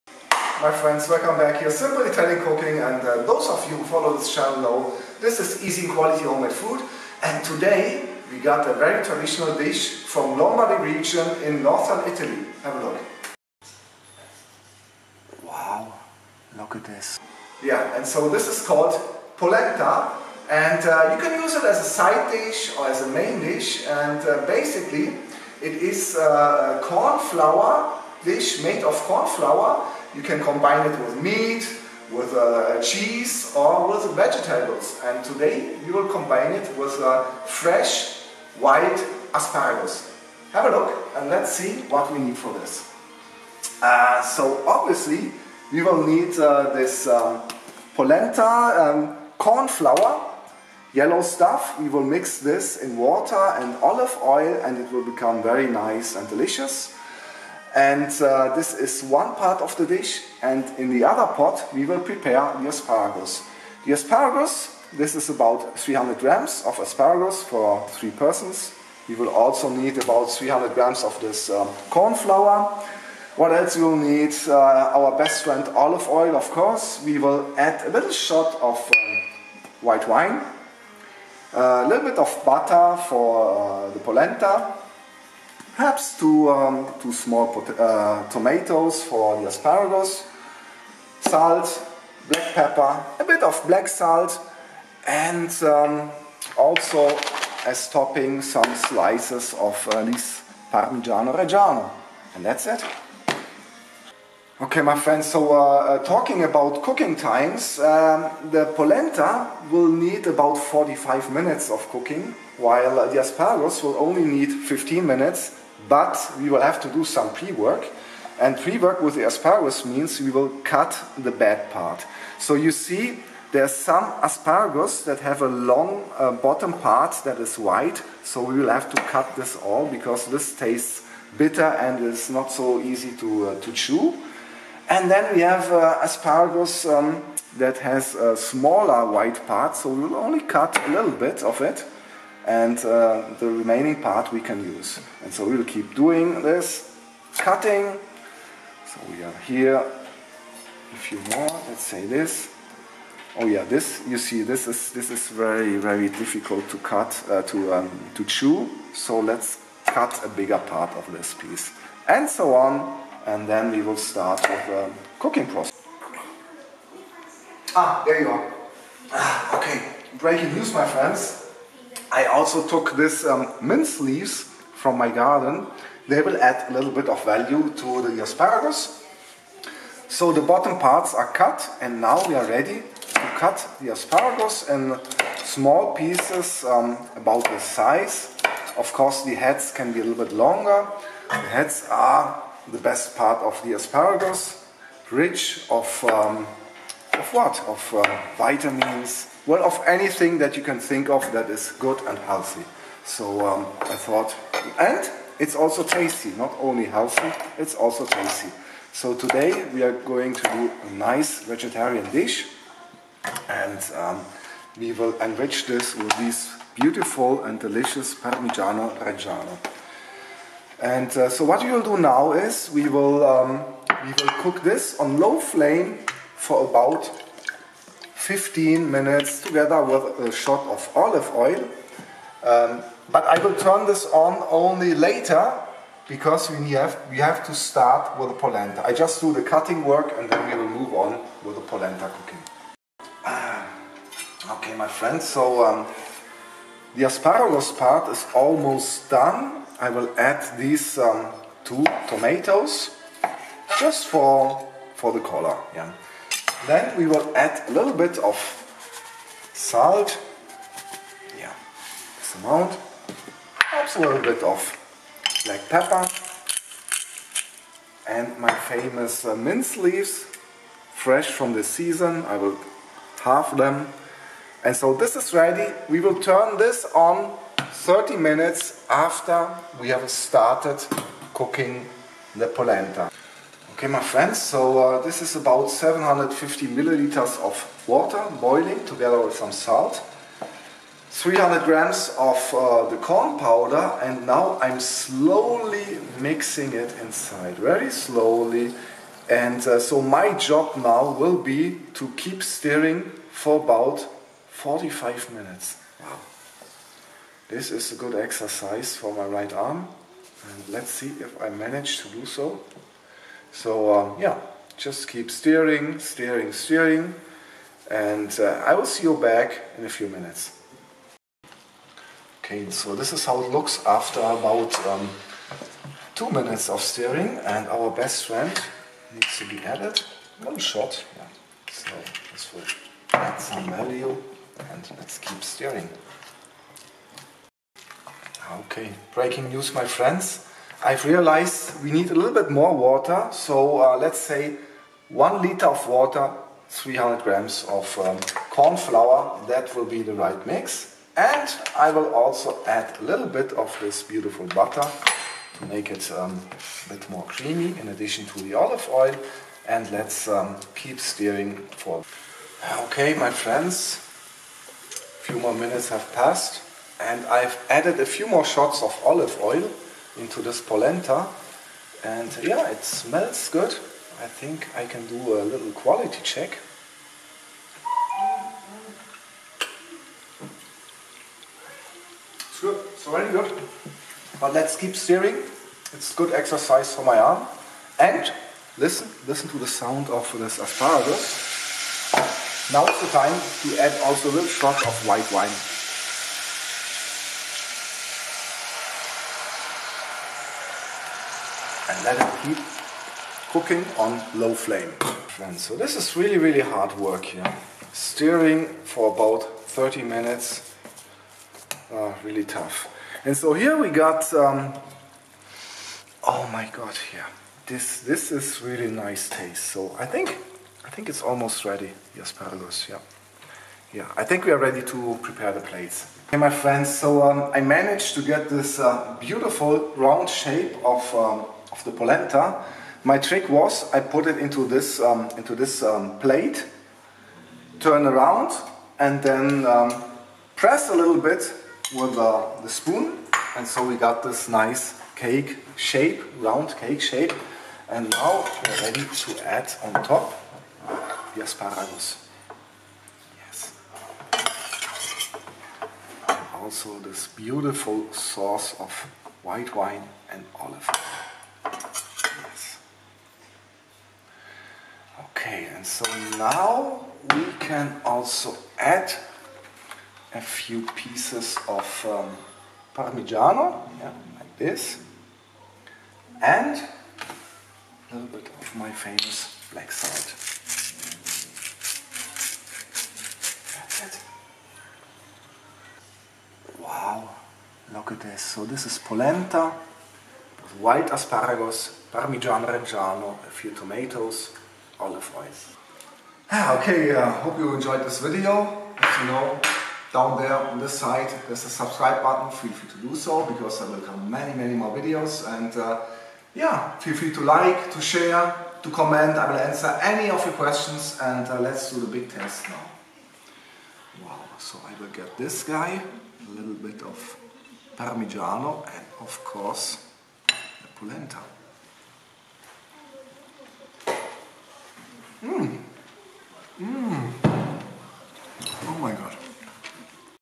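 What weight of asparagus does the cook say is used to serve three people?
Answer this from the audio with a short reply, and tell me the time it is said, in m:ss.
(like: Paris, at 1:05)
300 grams, at 1:05.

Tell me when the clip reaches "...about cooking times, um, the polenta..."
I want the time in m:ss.
1:46.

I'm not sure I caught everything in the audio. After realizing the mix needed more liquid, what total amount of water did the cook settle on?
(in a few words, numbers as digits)
1 liter.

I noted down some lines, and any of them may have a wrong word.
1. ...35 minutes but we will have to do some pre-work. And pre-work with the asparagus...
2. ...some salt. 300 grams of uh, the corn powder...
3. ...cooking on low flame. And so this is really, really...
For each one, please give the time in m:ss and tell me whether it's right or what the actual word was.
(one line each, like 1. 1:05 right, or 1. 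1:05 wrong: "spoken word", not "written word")
1. 1:54 wrong: "15", not "35"
2. 4:49 right
3. 6:43 right.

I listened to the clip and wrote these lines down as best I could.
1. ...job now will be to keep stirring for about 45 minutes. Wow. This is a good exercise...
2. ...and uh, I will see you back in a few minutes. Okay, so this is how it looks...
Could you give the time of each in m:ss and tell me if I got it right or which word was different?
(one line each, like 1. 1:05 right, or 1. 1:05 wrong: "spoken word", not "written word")
1. 5:00 right
2. 5:17 right.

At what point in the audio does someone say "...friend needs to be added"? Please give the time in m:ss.
5:28.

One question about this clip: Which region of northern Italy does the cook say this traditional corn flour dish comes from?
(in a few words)
Lombardy.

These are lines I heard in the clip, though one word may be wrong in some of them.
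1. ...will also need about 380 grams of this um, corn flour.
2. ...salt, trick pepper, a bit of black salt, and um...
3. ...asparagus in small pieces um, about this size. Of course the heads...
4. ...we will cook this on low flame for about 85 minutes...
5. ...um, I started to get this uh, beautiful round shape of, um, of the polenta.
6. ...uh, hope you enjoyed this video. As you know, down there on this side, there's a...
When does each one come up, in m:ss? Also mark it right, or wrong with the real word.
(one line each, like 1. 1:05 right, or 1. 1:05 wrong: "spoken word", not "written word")
1. 1:09 wrong: "300", not "380"
2. 1:31 wrong: "black", not "trick"
3. 3:03 right
4. 3:44 wrong: "15", not "85"
5. 7:07 wrong: "managed", not "started"
6. 8:17 right.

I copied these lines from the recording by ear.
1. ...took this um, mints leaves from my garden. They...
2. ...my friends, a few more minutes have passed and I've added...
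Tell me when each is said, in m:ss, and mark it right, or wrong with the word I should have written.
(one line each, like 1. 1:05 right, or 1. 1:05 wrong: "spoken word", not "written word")
1. 2:52 right
2. 6:03 right.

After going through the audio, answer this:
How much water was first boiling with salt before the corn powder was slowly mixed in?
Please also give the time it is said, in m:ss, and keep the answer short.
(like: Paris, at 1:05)
750 milliliters, at 4:45.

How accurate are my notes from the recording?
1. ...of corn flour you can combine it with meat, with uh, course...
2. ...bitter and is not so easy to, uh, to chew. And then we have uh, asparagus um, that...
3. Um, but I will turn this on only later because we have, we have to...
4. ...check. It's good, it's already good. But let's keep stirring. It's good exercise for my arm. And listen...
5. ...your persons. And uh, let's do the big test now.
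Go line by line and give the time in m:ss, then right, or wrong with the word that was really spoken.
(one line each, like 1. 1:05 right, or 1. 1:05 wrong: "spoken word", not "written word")
1. 0:28 wrong: "cheese", not "course"
2. 2:11 right
3. 3:52 right
4. 6:16 right
5. 8:30 wrong: "questions", not "persons".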